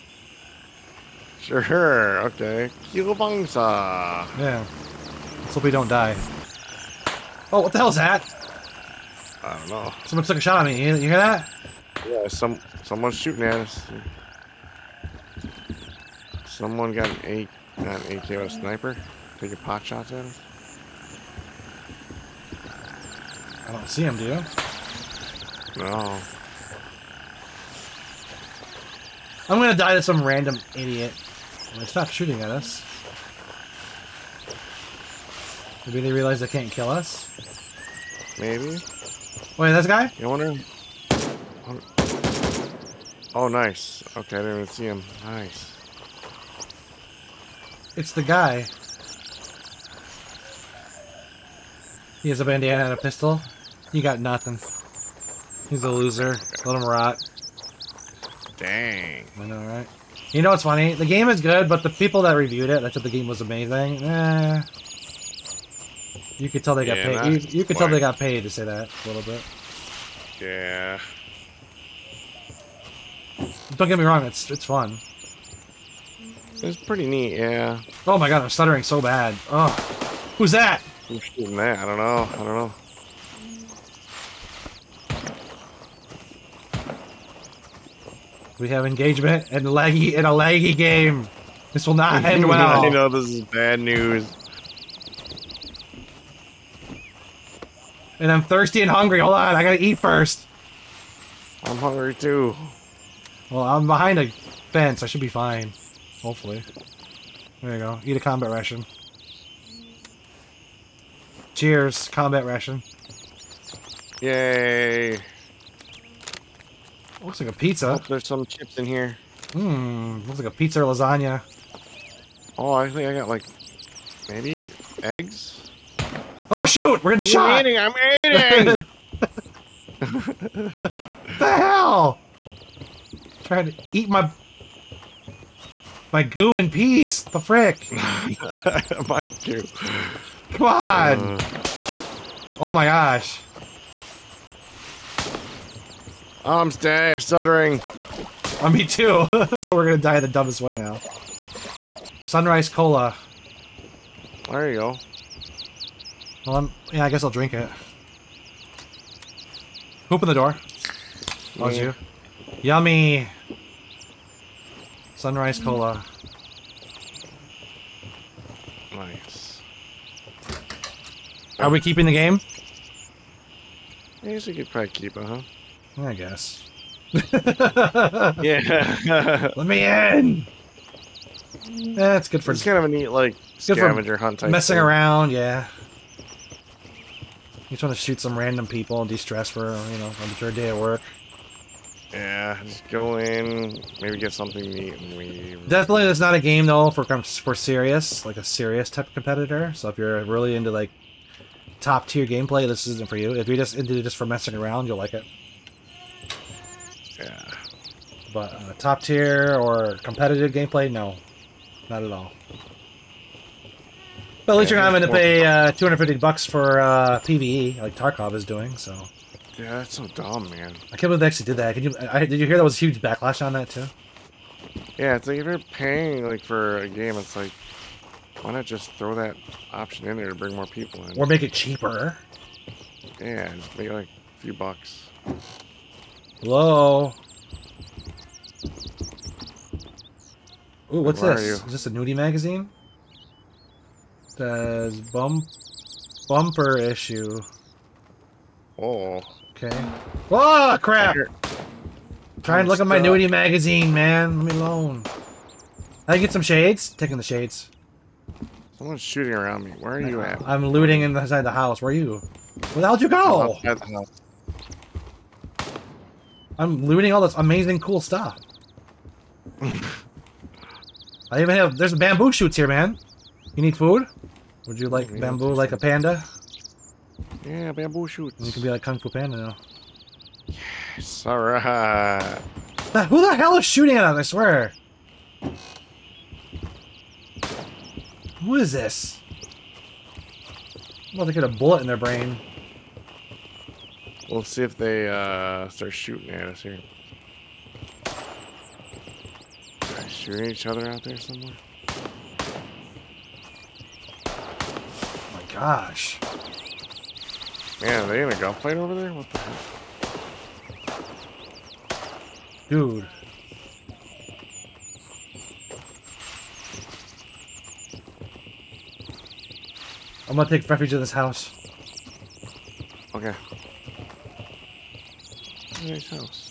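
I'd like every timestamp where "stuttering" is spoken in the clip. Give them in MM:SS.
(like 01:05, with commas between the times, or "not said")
01:18, 02:27.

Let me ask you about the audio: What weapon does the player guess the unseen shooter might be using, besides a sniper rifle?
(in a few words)
AK.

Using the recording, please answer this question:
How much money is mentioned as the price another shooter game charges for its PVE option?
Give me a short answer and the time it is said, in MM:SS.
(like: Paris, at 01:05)
$250, at 03:35.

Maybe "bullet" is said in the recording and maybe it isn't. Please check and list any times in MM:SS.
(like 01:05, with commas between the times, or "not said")
04:51.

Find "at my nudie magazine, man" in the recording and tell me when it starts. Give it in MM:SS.
04:12.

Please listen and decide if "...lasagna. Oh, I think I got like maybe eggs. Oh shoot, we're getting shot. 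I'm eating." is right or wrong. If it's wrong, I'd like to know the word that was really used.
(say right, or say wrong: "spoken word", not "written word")
right.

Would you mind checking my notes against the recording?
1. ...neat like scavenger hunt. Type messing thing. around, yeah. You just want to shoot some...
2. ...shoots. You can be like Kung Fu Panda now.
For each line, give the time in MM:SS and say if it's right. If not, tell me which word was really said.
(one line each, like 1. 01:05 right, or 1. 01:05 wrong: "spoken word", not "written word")
1. 03:02 right
2. 04:38 right.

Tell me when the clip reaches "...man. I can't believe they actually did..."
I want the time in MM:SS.
03:40.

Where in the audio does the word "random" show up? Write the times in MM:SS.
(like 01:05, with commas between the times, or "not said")
00:30, 03:08.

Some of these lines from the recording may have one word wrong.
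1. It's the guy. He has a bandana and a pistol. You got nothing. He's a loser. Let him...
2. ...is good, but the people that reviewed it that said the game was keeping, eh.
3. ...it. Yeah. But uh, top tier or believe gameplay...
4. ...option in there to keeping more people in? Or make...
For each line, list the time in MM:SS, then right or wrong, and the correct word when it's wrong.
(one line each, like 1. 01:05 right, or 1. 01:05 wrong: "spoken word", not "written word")
1. 00:47 right
2. 01:01 wrong: "amazing", not "keeping"
3. 03:25 wrong: "competitive", not "believe"
4. 03:49 wrong: "bring", not "keeping".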